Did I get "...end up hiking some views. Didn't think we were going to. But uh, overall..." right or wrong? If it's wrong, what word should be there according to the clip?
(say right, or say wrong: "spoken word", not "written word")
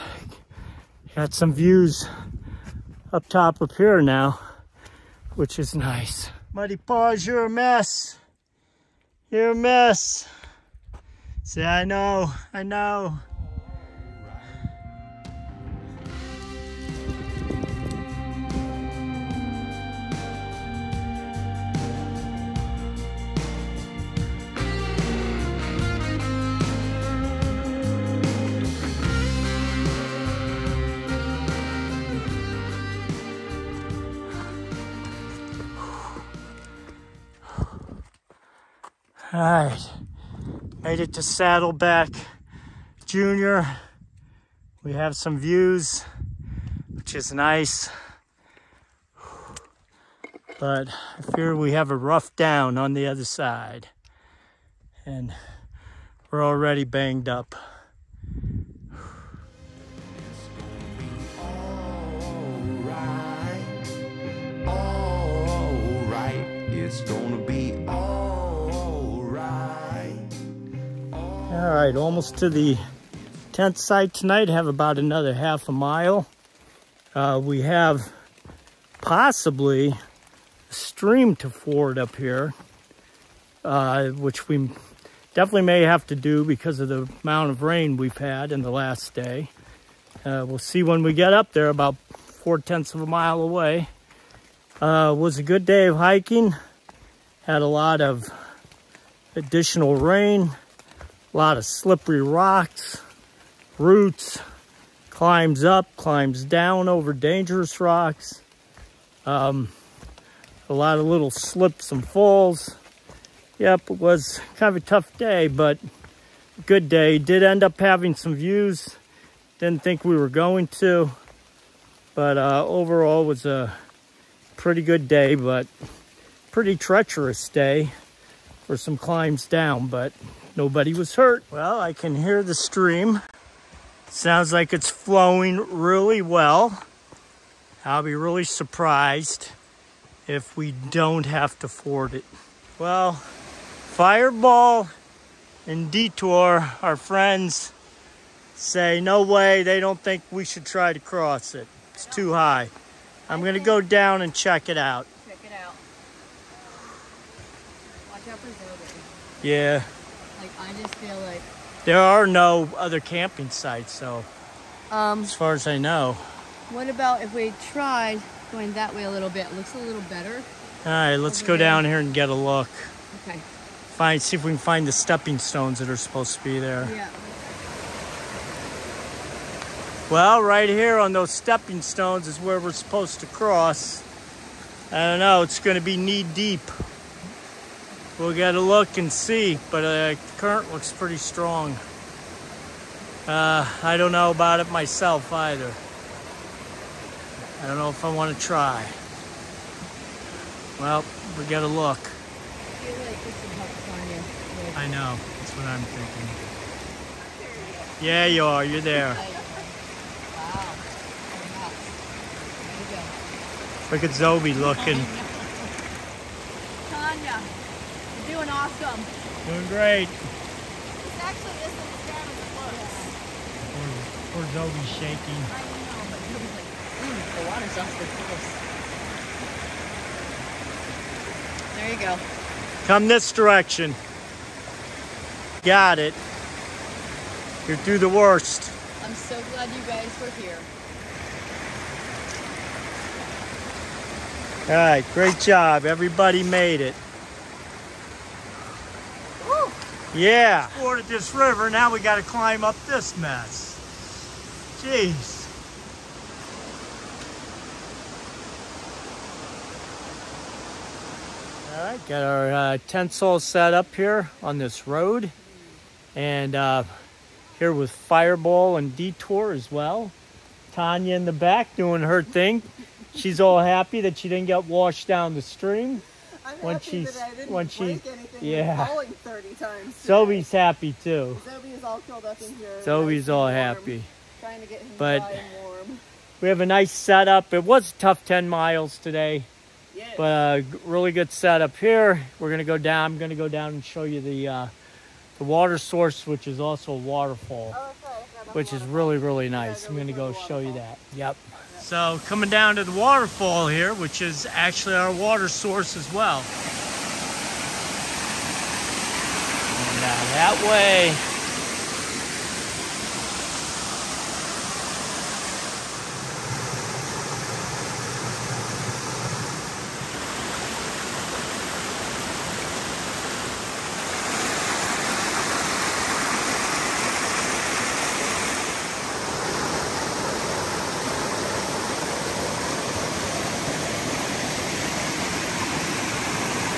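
wrong: "having", not "hiking".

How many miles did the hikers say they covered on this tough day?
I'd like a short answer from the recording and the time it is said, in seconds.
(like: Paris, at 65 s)
10 miles, at 288 s.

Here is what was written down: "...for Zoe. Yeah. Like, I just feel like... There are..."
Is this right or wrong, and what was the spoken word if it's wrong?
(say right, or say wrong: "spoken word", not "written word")
right.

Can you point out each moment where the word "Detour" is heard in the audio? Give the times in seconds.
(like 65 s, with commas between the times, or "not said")
145 s, 268 s.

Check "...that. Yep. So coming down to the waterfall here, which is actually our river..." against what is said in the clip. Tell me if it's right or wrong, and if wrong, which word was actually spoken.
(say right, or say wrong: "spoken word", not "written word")
wrong: "water", not "river".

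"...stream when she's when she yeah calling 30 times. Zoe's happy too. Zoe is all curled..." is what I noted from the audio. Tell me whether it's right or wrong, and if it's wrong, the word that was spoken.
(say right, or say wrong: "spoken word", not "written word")
right.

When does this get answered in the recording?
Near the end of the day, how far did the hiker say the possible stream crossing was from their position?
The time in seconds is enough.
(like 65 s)
92 s.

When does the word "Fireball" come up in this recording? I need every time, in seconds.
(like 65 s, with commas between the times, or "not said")
143 s, 267 s.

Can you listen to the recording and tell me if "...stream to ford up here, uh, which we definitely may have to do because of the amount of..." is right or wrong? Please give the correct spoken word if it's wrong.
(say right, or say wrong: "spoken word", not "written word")
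right.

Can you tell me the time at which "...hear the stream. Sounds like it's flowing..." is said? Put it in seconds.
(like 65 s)
132 s.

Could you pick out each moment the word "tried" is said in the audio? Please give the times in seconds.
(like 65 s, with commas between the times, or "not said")
167 s.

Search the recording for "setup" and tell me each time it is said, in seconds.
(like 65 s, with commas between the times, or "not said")
286 s, 291 s.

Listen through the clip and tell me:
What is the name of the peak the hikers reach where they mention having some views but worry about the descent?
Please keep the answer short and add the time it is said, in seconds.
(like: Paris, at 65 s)
Saddleback Junior, at 41 s.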